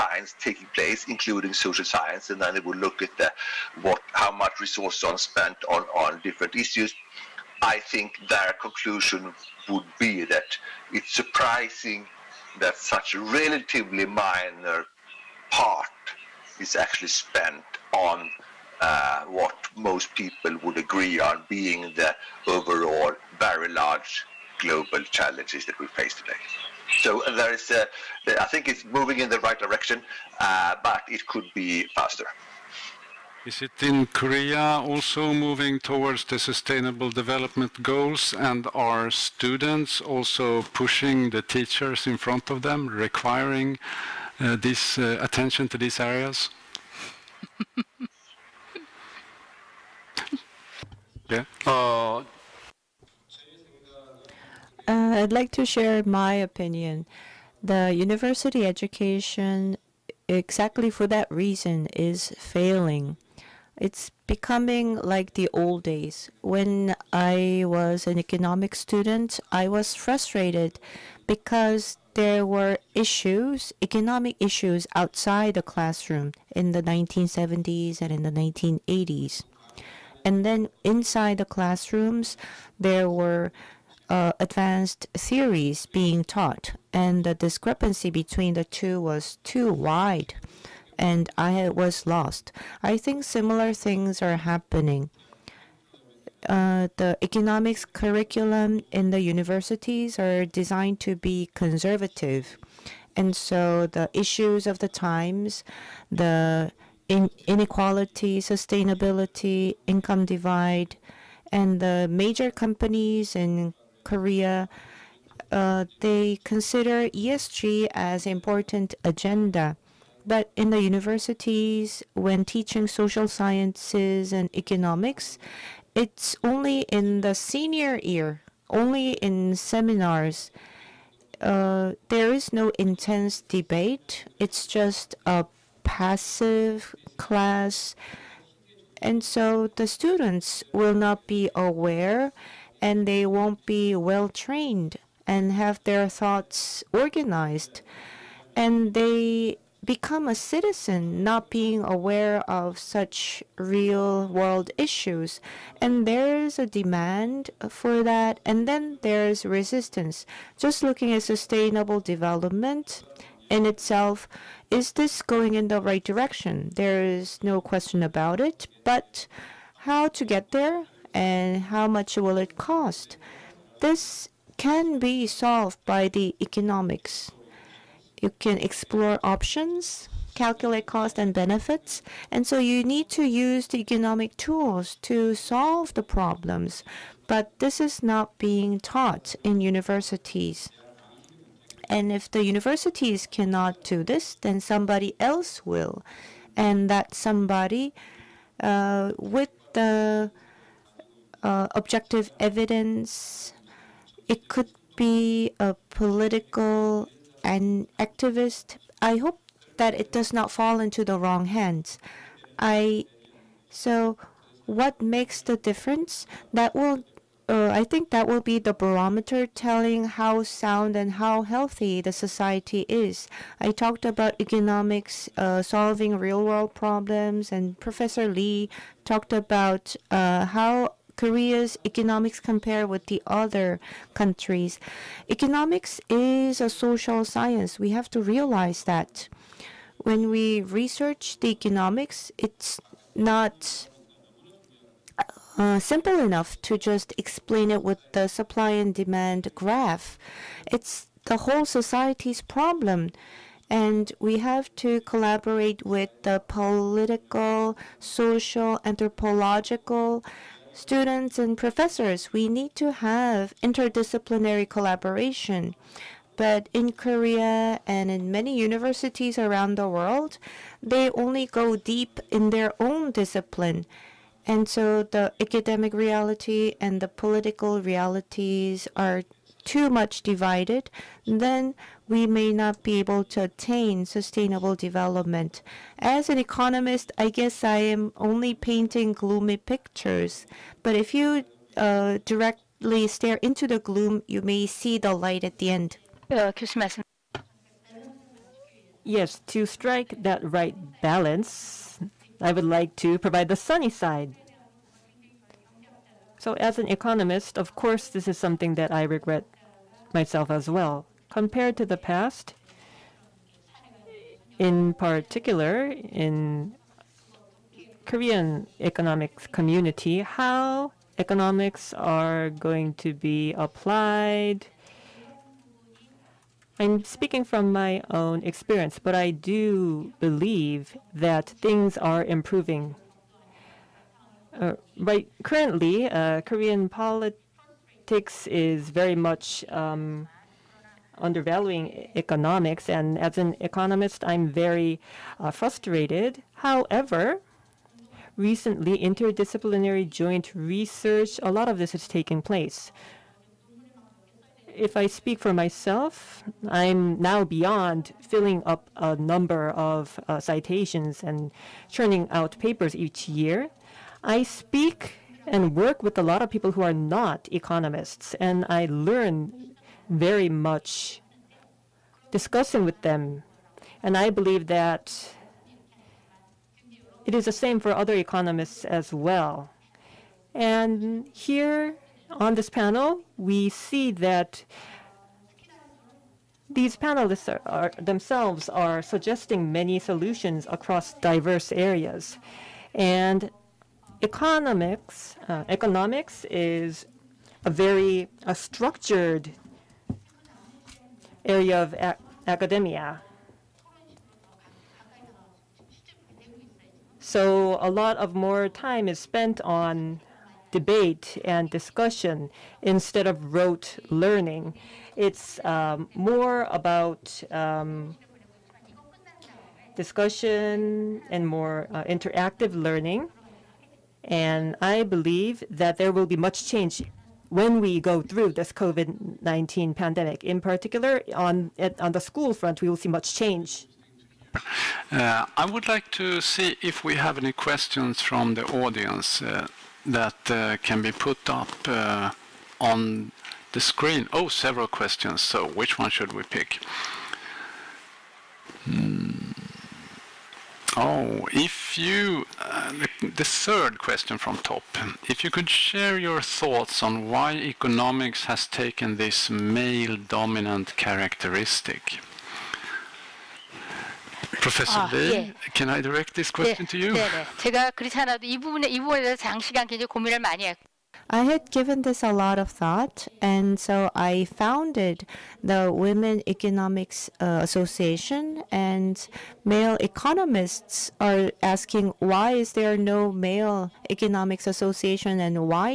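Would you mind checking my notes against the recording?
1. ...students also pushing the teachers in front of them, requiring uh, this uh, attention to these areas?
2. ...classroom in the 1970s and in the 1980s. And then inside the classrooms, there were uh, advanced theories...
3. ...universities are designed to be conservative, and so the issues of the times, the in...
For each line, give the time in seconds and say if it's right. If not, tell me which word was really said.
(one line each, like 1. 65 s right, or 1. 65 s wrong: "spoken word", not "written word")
1. 39 s right
2. 75 s right
3. 99 s right.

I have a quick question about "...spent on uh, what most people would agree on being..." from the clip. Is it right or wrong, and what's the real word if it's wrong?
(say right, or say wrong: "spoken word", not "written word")
right.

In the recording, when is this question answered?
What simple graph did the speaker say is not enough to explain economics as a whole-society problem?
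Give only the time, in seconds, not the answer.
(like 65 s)
248 s.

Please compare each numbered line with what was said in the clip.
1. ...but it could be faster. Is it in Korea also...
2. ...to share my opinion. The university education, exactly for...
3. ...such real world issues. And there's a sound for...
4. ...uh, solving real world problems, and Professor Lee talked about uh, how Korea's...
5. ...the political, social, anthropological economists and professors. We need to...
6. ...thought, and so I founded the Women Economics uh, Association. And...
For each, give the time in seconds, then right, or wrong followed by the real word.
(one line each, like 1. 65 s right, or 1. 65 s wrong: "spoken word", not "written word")
1. 30 s right
2. 55 s right
3. 152 s wrong: "demand", not "sound"
4. 225 s right
5. 256 s wrong: "students", not "economists"
6. 472 s right.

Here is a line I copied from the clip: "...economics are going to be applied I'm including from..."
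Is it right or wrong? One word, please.
wrong.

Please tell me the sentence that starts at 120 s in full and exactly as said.
But in the universities, when teaching social sciences and economics, it's only in the senior year, only in seminars.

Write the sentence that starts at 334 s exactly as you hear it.
Uh, right currently, uh, Korean politics is very much um, undervaluing economics, and as an economist, I'm very uh, frustrated.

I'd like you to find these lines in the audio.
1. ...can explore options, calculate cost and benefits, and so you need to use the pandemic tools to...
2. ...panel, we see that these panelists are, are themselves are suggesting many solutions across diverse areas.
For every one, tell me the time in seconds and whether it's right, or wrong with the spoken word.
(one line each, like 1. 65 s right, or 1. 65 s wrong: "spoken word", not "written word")
1. 178 s wrong: "economic", not "pandemic"
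2. 382 s right.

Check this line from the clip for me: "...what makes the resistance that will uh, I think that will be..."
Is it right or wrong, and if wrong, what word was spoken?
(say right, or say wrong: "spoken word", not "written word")
wrong: "difference", not "resistance".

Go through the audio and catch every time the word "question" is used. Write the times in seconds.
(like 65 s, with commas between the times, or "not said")
167 s, 437 s, 444 s, 453 s, 466 s.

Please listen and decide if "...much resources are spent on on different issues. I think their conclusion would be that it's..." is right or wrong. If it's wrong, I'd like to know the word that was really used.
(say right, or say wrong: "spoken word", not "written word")
right.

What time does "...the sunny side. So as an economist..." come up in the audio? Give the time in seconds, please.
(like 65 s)
303 s.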